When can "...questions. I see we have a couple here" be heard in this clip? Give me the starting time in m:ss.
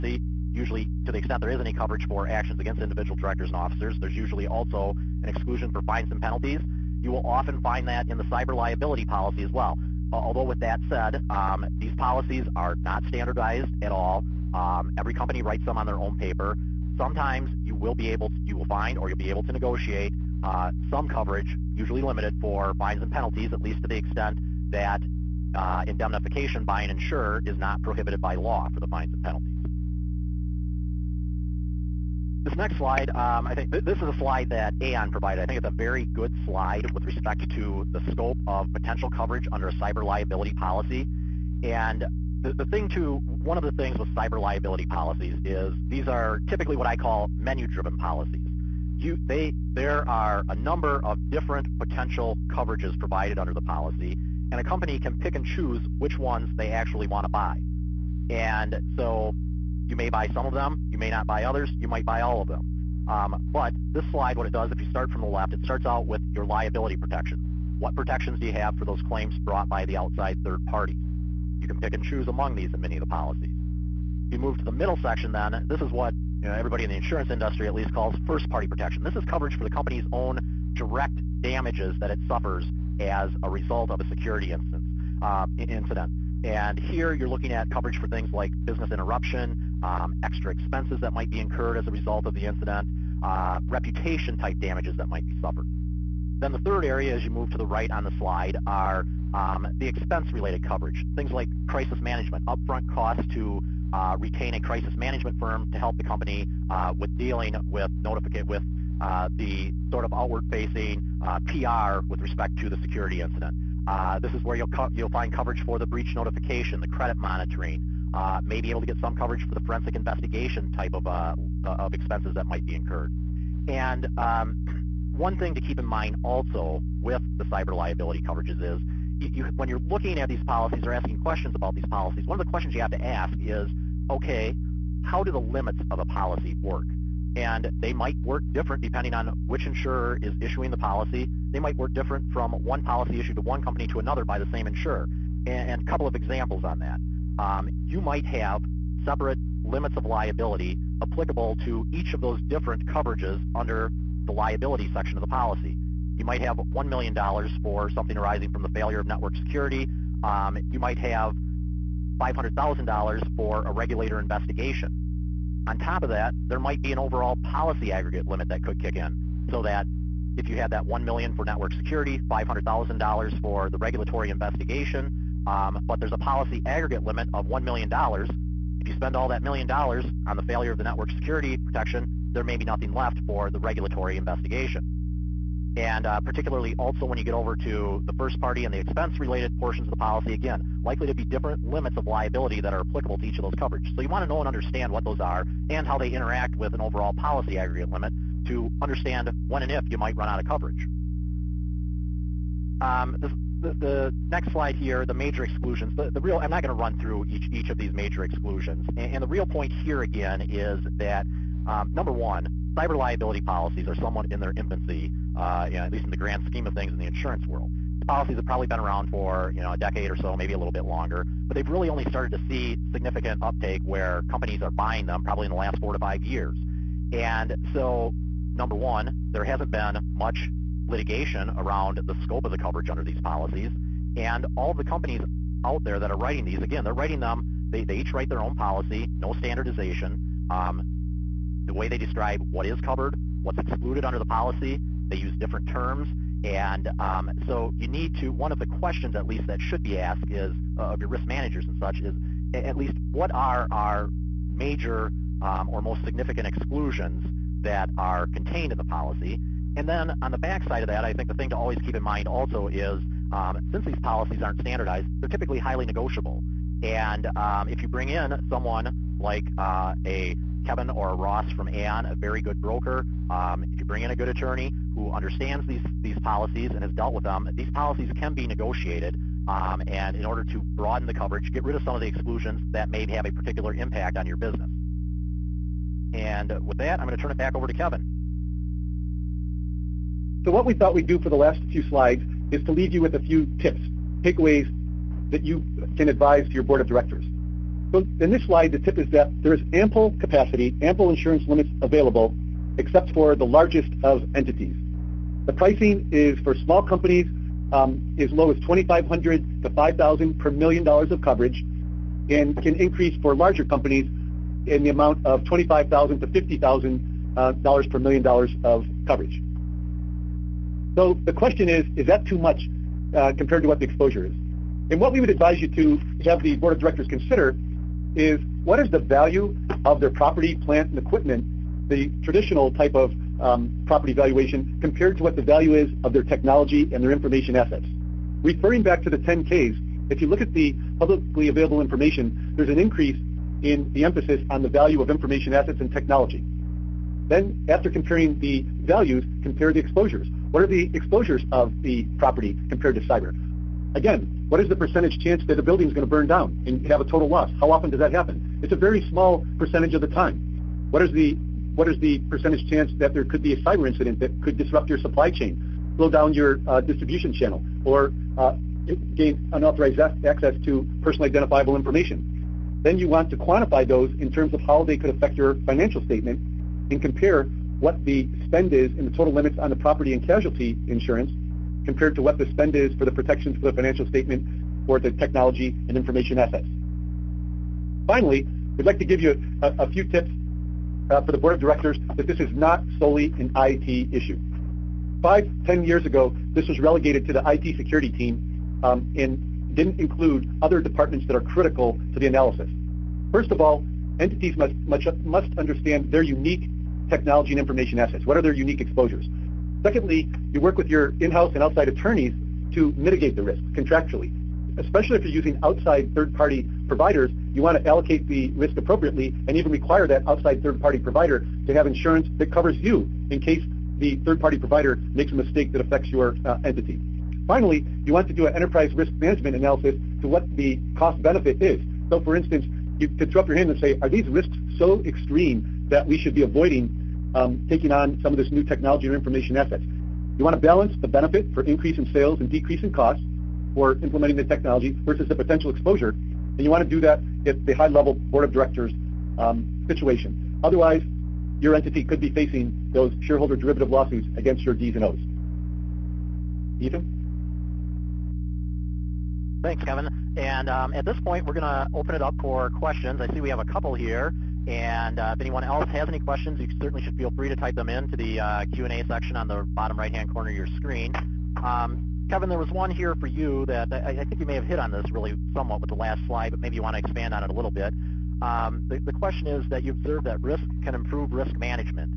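7:42.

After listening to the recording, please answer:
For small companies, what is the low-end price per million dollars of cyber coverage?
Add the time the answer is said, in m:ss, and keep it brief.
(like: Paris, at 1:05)
$2,500, at 5:08.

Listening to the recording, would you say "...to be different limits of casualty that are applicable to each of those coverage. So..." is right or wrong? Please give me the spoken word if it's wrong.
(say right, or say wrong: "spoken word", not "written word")
wrong: "liability", not "casualty".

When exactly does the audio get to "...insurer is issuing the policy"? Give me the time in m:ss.
2:19.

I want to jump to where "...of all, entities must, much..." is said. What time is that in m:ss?
6:43.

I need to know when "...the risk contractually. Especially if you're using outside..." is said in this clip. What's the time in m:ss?
6:53.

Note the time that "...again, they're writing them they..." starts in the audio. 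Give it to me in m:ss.
3:56.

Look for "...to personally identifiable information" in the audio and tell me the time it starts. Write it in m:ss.
6:10.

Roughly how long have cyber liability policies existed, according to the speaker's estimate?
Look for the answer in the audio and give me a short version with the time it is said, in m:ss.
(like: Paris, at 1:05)
a decade, at 3:39.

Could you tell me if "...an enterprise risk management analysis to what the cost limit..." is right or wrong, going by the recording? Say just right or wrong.
wrong.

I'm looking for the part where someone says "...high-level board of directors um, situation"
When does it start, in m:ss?
7:27.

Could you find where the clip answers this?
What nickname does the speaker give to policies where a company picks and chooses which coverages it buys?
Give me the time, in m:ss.
0:47.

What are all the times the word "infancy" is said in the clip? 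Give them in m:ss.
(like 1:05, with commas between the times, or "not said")
3:34.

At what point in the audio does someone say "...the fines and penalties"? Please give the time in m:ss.
0:28.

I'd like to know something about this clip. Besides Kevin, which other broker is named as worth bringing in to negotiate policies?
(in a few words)
Ross.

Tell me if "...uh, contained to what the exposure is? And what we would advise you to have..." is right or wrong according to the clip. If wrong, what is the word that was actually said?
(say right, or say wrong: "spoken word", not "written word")
wrong: "compared", not "contained".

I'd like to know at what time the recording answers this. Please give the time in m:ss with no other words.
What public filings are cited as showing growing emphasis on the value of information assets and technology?
5:39.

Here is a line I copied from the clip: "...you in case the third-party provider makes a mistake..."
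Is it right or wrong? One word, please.
right.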